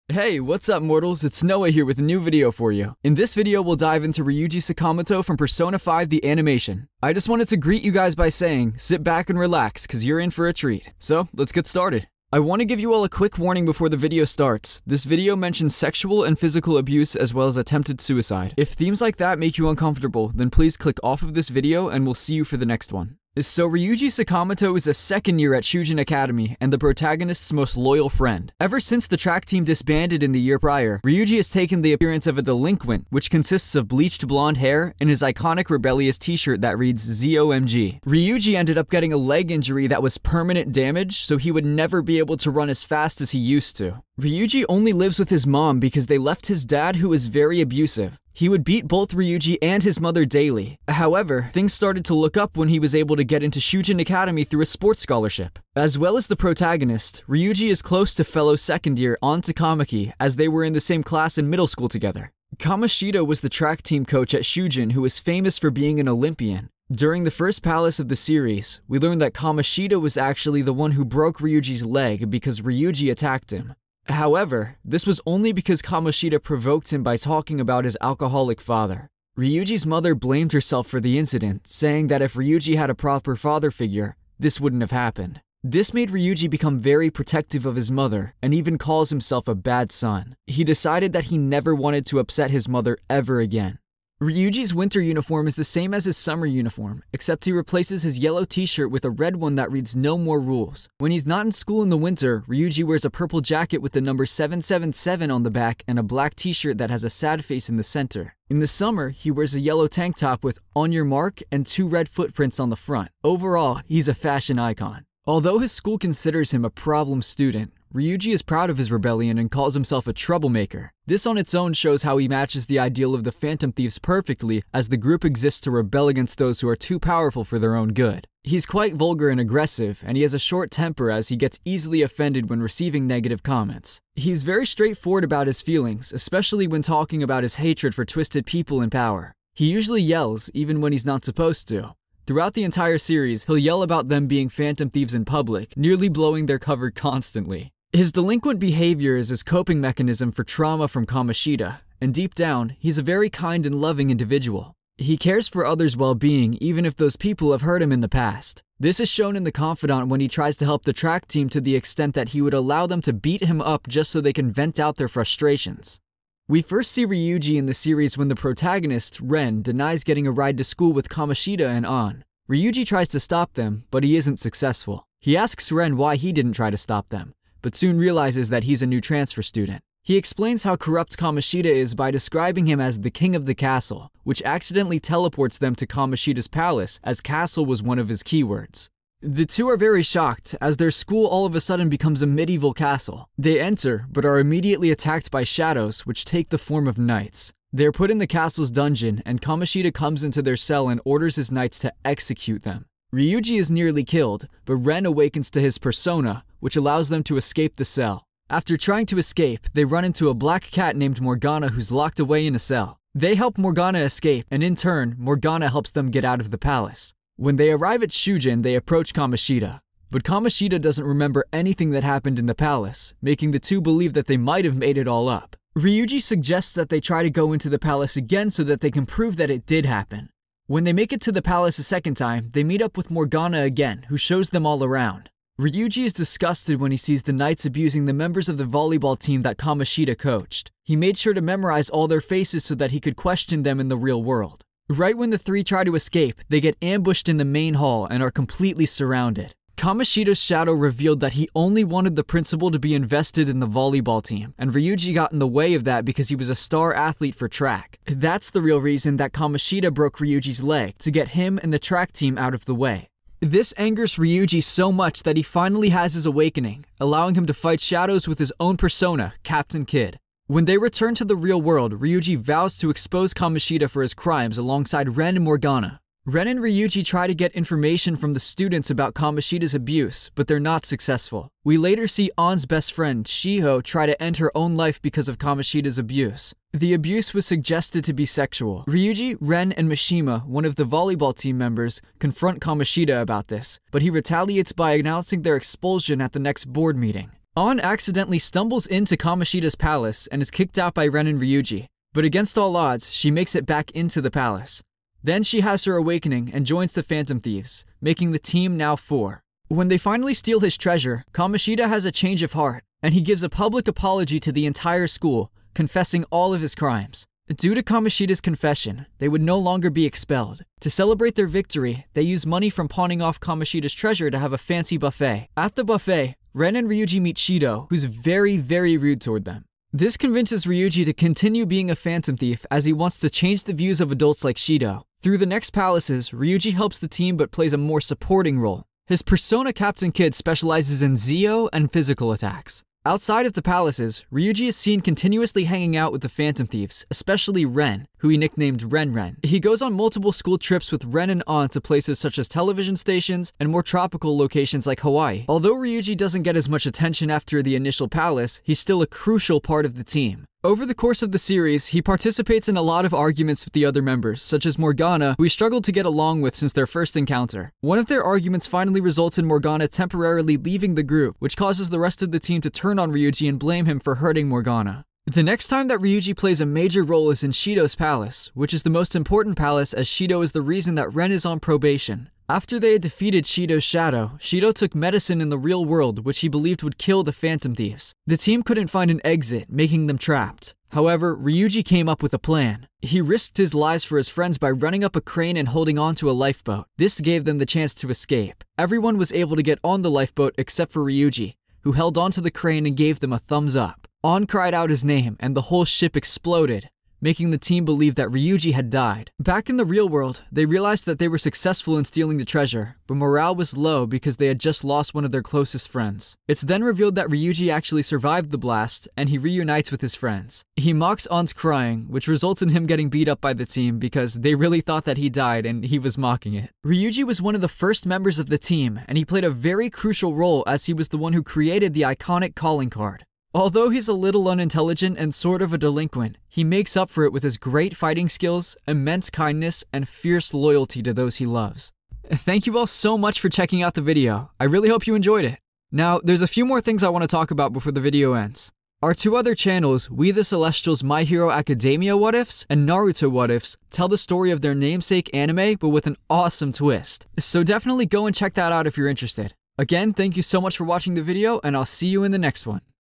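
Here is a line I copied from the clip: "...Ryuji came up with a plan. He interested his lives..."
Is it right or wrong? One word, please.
wrong.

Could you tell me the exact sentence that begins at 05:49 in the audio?
He goes on multiple school trips with Ren and Ann to places such as television stations and more tropical locations like Hawaii.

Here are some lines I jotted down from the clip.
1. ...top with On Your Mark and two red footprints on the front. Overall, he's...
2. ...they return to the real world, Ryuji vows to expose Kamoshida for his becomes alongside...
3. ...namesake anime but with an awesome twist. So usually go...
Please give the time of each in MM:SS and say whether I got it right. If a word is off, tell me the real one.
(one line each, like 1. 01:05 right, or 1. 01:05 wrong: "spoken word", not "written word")
1. 01:50 right
2. 04:30 wrong: "crimes", not "becomes"
3. 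07:34 wrong: "definitely", not "usually".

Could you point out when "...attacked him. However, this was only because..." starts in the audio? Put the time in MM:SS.
01:13.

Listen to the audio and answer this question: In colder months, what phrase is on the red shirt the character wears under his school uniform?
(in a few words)
No More Rules.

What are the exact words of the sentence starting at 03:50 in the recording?
When they make it to the palace a second time, they meet up with Morgana again, who shows them all around.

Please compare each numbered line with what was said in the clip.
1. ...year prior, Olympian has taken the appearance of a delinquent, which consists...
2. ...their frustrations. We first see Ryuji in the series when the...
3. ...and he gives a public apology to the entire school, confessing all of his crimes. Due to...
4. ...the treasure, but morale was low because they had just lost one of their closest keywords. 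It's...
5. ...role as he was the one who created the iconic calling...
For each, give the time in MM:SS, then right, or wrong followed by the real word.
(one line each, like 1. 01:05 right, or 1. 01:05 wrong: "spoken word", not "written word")
1. 00:30 wrong: "Ryuji", not "Olympian"
2. 02:44 right
3. 05:13 right
4. 06:52 wrong: "friends", not "keywords"
5. 07:10 right.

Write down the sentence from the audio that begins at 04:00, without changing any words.
He made sure to memorize all their faces so that he could question them in the real world.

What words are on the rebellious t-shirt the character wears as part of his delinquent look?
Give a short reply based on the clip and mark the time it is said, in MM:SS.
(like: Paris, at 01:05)
ZOMG, at 00:37.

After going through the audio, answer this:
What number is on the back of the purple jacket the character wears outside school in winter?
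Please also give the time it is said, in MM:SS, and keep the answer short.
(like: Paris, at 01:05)
777, at 01:44.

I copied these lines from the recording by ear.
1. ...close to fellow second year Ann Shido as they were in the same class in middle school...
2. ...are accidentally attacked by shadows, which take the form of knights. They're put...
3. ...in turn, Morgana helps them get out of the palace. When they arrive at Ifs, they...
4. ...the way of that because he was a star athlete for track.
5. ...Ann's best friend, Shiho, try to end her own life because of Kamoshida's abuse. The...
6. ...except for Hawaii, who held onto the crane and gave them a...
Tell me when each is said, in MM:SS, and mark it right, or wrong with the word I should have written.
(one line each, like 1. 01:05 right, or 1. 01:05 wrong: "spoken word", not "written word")
1. 00:57 wrong: "Takamaki", not "Shido"
2. 03:14 wrong: "immediately", not "accidentally"
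3. 03:34 wrong: "Shujin", not "Ifs"
4. 04:15 right
5. 04:42 right
6. 06:40 wrong: "Ryuji", not "Hawaii".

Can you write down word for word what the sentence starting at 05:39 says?
His persona Captain Kidd specializes in Zio and physical attacks.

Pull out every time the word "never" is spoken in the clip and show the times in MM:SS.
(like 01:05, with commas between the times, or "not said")
00:41, 01:31.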